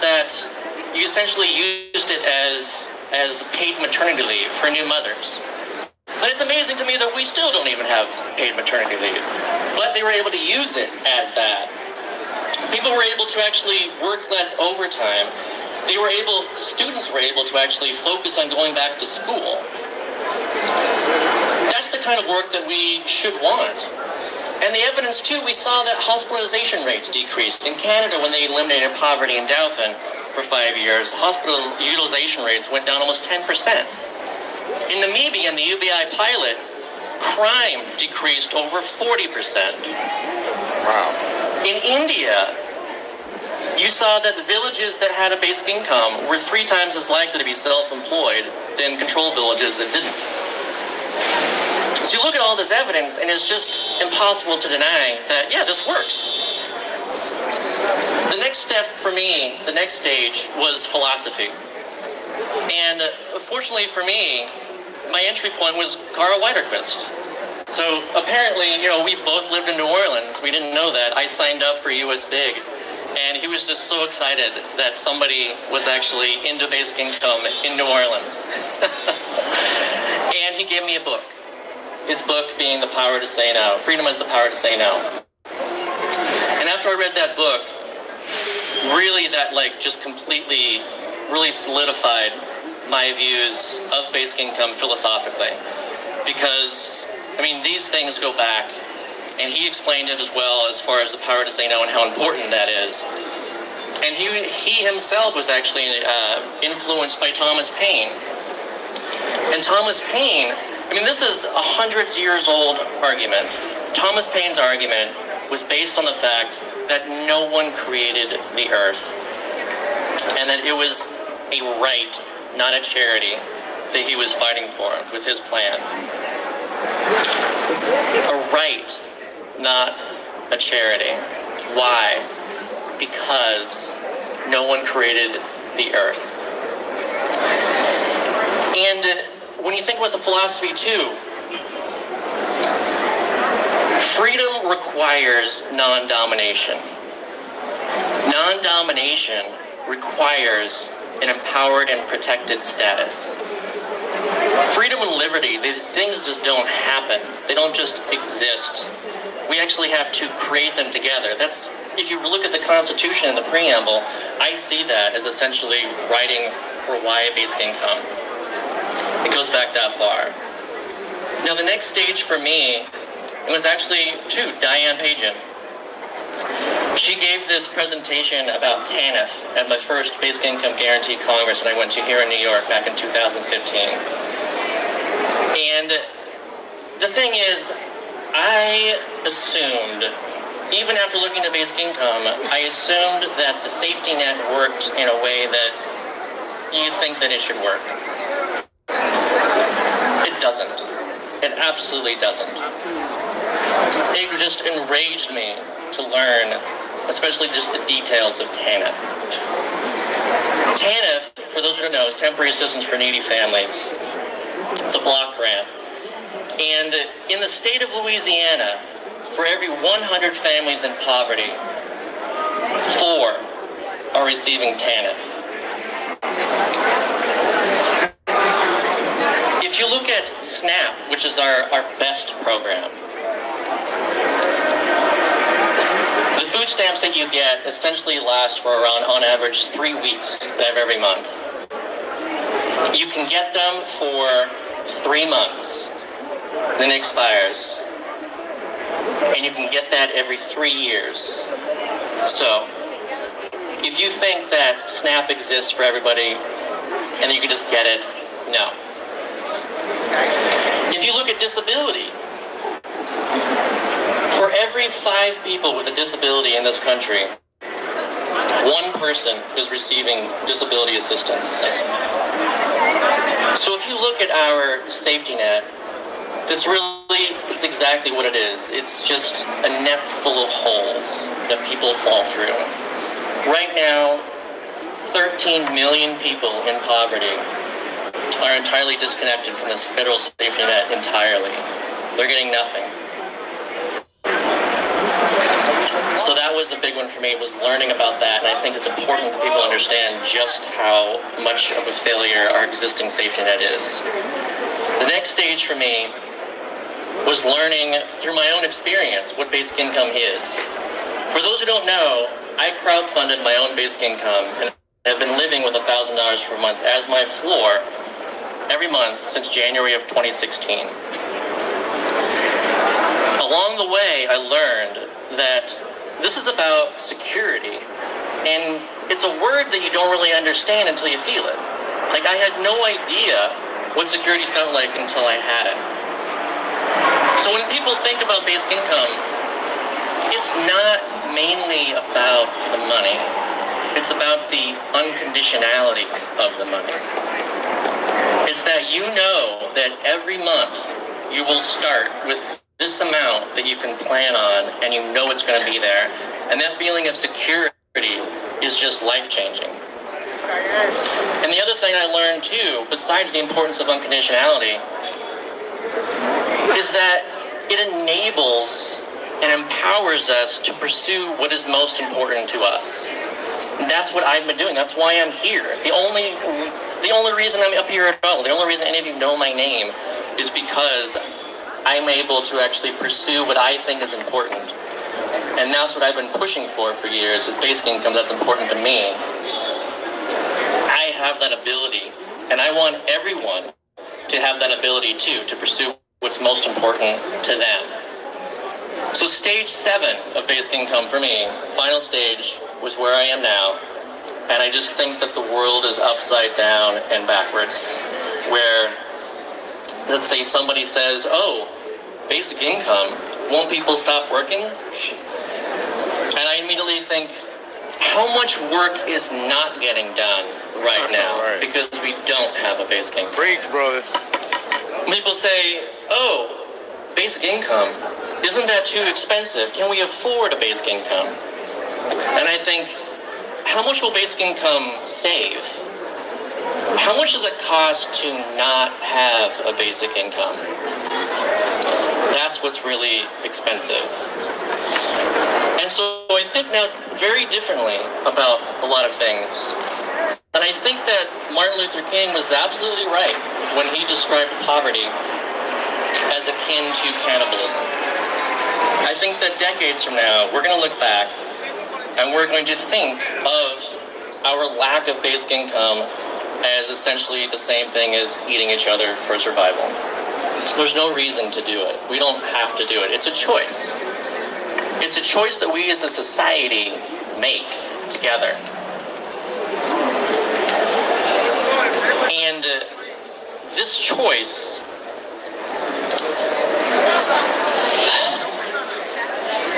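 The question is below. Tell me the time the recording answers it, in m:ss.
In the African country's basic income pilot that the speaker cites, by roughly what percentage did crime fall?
0:38.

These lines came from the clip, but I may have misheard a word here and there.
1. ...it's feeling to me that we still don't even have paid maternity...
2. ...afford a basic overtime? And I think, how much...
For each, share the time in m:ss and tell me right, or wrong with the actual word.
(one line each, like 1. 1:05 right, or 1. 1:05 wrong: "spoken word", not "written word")
1. 0:06 wrong: "amazing", not "feeling"
2. 7:10 wrong: "income", not "overtime".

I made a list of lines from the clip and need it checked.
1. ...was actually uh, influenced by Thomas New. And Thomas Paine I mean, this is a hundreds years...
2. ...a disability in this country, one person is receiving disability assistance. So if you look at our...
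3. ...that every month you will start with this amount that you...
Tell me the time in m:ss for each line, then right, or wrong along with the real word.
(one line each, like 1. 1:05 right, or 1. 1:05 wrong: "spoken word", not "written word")
1. 1:45 wrong: "Paine", not "New"
2. 4:25 right
3. 5:49 right.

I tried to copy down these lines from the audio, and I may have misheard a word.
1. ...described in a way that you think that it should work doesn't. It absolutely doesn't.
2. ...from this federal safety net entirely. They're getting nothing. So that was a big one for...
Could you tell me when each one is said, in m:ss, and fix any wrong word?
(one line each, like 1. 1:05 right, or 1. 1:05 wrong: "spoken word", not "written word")
1. 3:14 wrong: "worked", not "described"
2. 4:49 right.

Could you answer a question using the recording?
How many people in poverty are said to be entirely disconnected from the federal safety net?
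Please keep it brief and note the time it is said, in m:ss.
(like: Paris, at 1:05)
13 million, at 4:45.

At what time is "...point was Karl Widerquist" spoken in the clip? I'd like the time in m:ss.
1:05.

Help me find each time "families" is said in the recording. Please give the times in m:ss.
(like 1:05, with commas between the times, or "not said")
3:33, 3:40.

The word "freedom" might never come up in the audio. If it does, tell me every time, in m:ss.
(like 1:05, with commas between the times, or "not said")
1:23, 2:24, 2:34.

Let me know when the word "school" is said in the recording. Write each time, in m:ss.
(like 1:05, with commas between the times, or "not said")
0:19.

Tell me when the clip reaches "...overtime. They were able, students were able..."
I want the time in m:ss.
0:14.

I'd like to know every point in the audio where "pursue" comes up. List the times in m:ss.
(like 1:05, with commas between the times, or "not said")
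6:10, 6:22, 6:35.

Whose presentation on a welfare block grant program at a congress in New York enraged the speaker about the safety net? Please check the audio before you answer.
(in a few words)
Diane Pagen.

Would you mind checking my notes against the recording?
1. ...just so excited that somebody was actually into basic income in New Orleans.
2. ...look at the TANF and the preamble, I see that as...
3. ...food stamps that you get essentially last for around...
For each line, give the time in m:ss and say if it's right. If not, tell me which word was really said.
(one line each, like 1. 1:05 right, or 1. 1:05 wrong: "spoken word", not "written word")
1. 1:13 right
2. 2:42 wrong: "Constitution", not "TANF"
3. 3:56 right.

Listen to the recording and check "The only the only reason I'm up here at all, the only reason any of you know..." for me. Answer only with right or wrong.
right.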